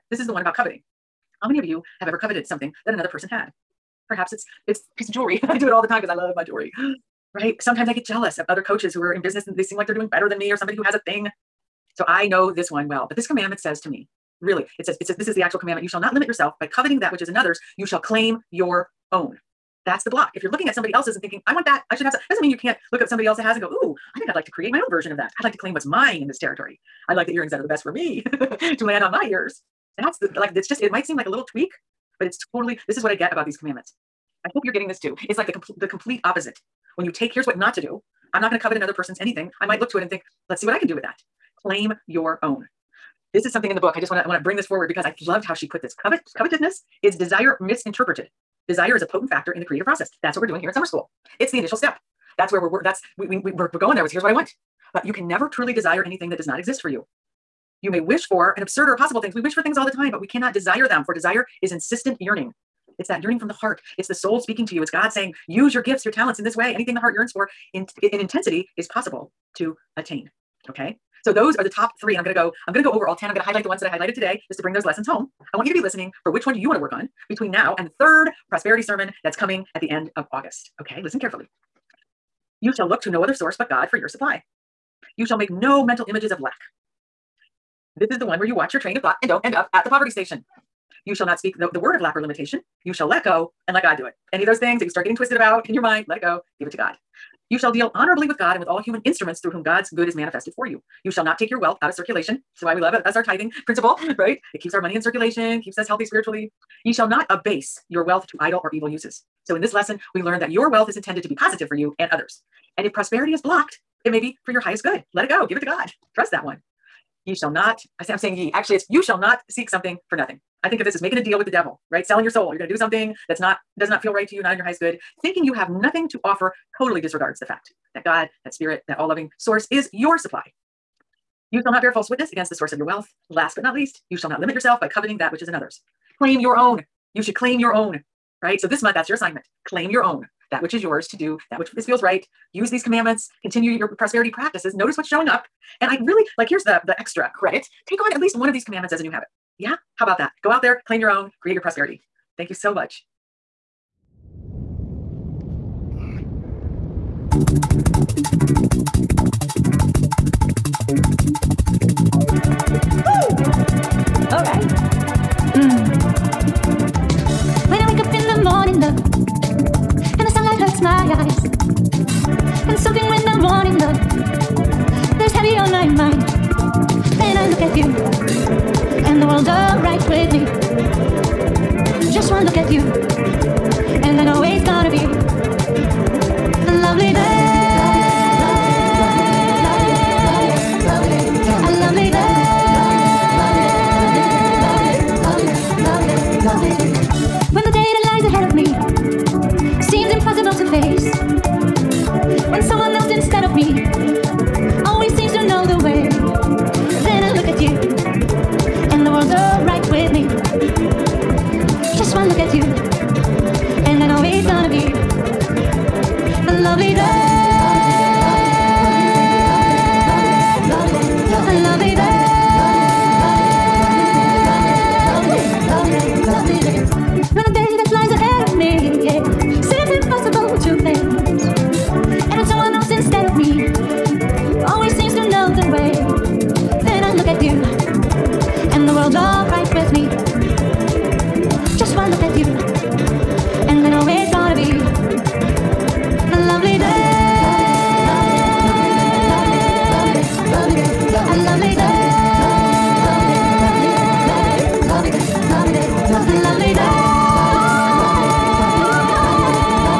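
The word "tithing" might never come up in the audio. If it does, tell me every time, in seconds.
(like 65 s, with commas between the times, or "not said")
103 s.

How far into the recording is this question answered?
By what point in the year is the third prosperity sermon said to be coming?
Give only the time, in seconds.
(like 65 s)
79 s.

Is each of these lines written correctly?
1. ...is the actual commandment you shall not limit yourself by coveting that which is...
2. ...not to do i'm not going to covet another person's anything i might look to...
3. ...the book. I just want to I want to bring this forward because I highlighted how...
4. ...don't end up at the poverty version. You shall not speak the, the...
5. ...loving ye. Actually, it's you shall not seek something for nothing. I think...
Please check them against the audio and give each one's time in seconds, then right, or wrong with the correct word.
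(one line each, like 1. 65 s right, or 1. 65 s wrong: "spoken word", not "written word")
1. 15 s right
2. 37 s right
3. 43 s wrong: "loved", not "highlighted"
4. 89 s wrong: "station", not "version"
5. 118 s wrong: "saying", not "loving".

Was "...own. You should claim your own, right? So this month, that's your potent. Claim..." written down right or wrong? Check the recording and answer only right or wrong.
wrong.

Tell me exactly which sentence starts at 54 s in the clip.
But you can never truly desire anything that does not exist for you you may wish for an absurd or impossible things.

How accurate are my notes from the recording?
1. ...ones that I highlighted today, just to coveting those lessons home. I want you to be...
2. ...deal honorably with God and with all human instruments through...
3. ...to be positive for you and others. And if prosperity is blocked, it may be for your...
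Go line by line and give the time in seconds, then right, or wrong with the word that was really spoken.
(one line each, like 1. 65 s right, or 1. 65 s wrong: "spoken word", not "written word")
1. 73 s wrong: "bring", not "coveting"
2. 97 s right
3. 111 s right.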